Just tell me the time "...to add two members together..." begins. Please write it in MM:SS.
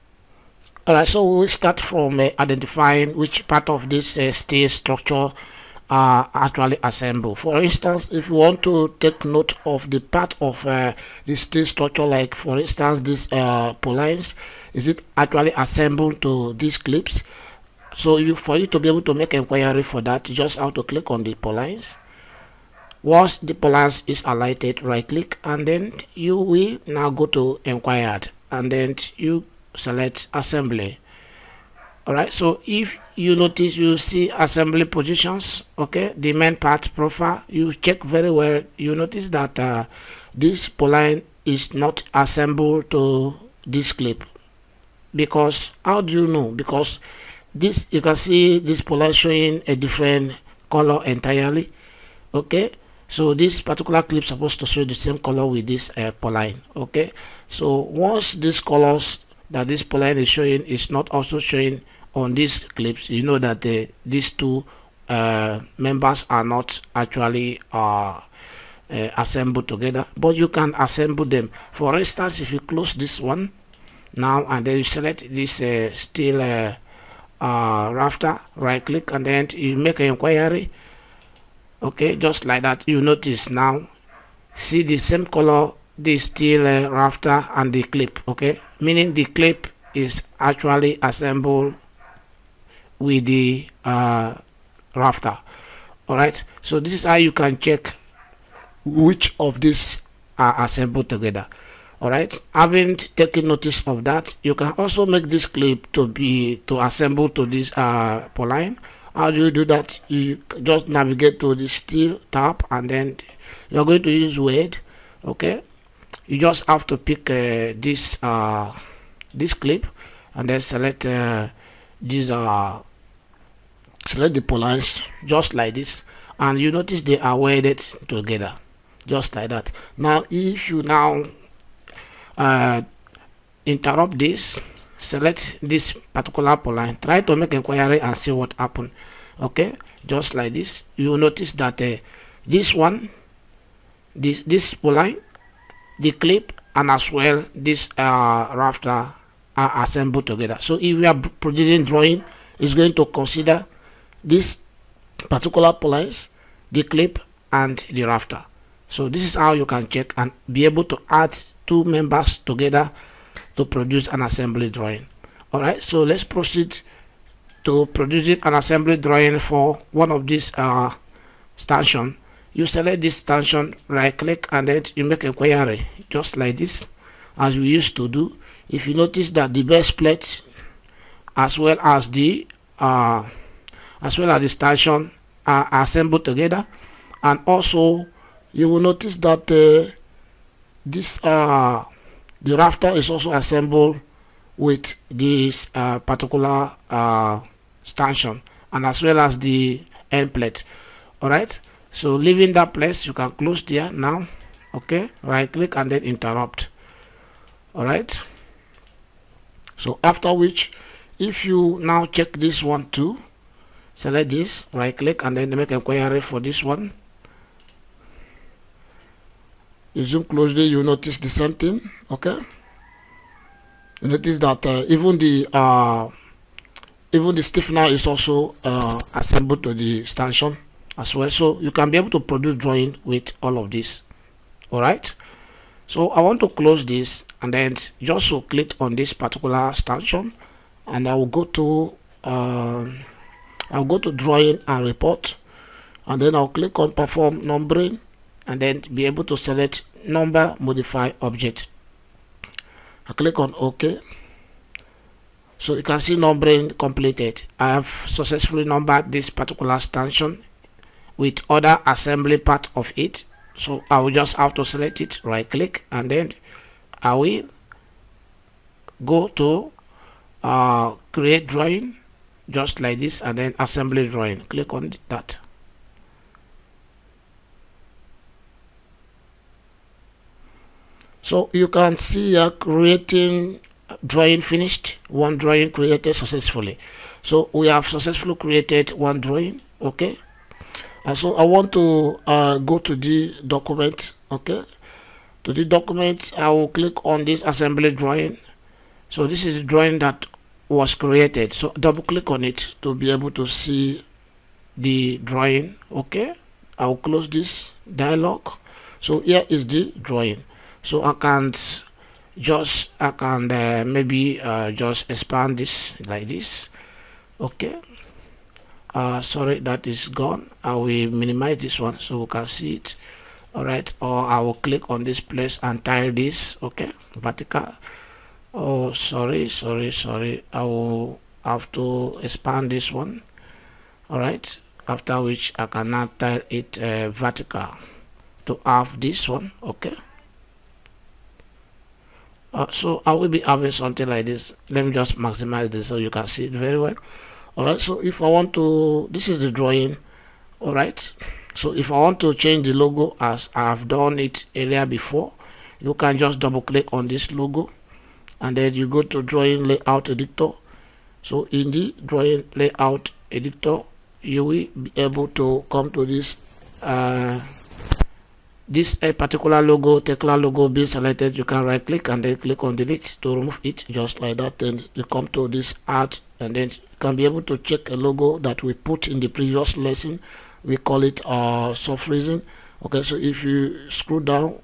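02:40.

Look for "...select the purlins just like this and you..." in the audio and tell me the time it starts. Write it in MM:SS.
02:04.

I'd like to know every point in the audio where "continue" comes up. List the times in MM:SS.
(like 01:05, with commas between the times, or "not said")
not said.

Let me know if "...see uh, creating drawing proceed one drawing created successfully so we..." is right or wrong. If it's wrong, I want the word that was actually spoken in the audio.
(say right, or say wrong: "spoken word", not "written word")
wrong: "finished", not "proceed".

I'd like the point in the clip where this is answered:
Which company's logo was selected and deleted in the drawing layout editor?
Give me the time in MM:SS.
06:09.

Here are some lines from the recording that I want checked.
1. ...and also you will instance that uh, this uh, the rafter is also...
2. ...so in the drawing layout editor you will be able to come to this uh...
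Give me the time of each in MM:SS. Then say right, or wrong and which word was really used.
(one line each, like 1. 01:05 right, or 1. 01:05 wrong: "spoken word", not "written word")
1. 03:07 wrong: "notice", not "instance"
2. 06:01 right.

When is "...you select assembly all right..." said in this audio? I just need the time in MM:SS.
00:29.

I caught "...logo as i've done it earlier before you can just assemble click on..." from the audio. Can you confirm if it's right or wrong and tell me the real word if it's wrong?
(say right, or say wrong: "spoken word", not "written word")
wrong: "double", not "assemble".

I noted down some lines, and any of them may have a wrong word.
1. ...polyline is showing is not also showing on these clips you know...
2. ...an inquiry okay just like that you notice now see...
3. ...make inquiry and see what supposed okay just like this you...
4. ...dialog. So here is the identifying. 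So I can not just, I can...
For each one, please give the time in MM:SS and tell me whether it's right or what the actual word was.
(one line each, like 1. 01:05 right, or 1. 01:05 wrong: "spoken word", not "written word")
1. 00:59 right
2. 01:19 right
3. 02:17 wrong: "happened", not "supposed"
4. 05:07 wrong: "drawing", not "identifying".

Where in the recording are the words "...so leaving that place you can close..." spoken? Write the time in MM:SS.
03:21.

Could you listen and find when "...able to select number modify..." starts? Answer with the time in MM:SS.
04:09.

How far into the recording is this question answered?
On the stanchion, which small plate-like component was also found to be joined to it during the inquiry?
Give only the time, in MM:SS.
03:47.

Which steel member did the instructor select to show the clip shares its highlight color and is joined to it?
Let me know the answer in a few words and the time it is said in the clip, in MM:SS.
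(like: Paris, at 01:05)
Steel rafter, at 01:15.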